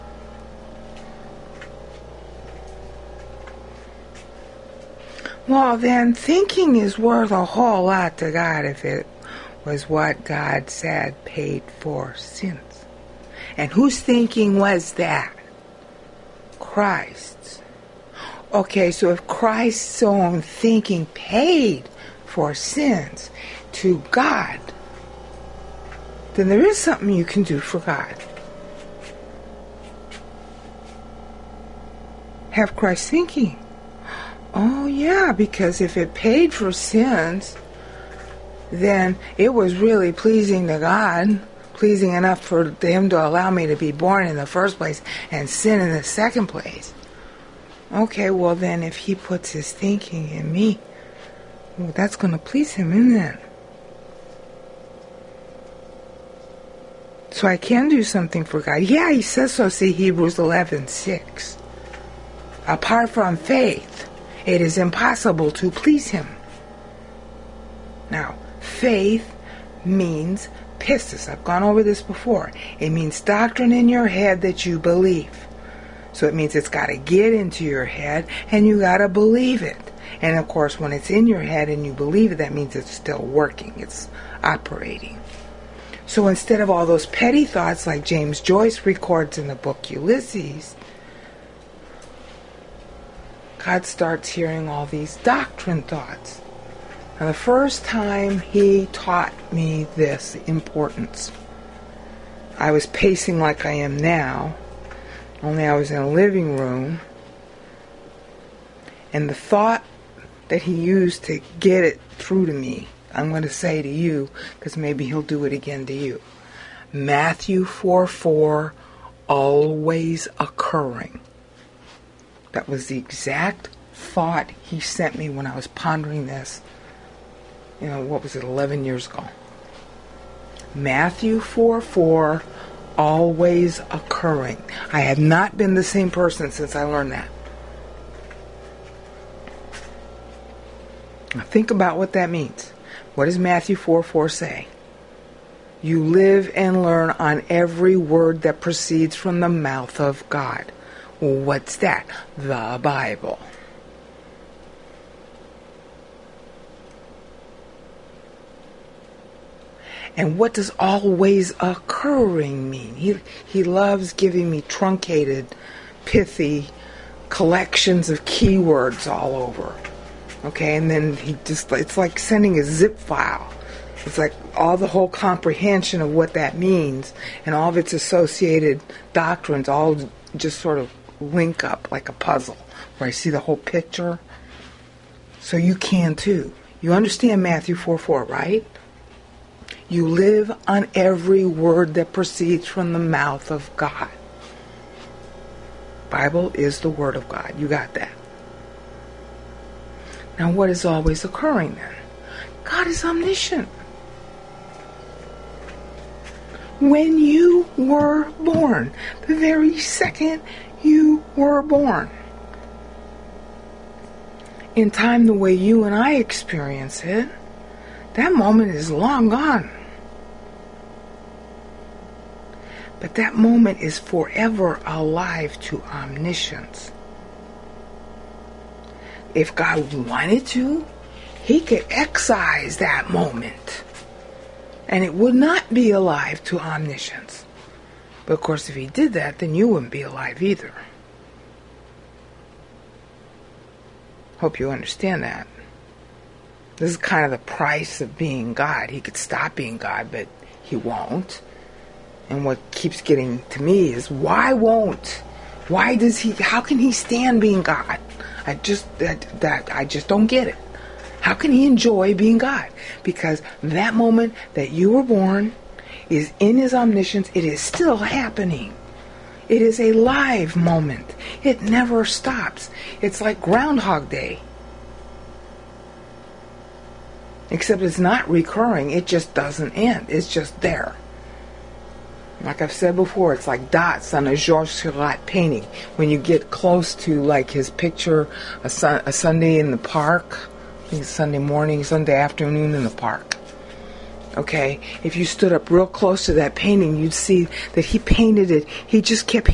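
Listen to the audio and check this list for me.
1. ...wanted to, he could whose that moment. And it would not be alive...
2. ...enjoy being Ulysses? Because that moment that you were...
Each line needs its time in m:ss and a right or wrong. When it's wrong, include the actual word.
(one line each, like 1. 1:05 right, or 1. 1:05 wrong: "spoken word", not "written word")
1. 3:50 wrong: "excise", not "whose"
2. 4:21 wrong: "God", not "Ulysses".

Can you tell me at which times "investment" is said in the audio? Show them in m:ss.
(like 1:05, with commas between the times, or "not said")
not said.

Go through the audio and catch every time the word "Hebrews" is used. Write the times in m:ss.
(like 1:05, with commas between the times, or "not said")
0:59.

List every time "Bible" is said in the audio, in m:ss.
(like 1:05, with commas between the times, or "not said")
2:32, 3:16.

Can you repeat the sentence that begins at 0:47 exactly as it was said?
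Okay, well, then if He puts His thinking in me, well, that's going to please Him, isn't it?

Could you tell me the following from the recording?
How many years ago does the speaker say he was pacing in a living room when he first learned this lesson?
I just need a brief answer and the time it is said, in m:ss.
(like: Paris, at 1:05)
11, at 2:08.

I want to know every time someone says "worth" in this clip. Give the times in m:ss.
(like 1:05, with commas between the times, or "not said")
0:06.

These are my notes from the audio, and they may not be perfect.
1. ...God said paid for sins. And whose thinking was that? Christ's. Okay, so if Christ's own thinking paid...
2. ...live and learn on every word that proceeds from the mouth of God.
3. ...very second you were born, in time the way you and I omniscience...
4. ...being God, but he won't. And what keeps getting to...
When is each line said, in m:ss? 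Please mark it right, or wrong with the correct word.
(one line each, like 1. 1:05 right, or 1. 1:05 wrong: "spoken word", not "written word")
1. 0:10 right
2. 2:26 right
3. 3:29 wrong: "experience", not "omniscience"
4. 4:09 right.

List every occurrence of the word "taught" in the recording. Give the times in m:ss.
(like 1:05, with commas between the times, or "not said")
1:38.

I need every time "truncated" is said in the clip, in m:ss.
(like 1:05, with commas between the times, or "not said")
2:44.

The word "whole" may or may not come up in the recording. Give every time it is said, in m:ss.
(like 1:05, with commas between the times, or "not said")
0:07, 2:54, 3:03.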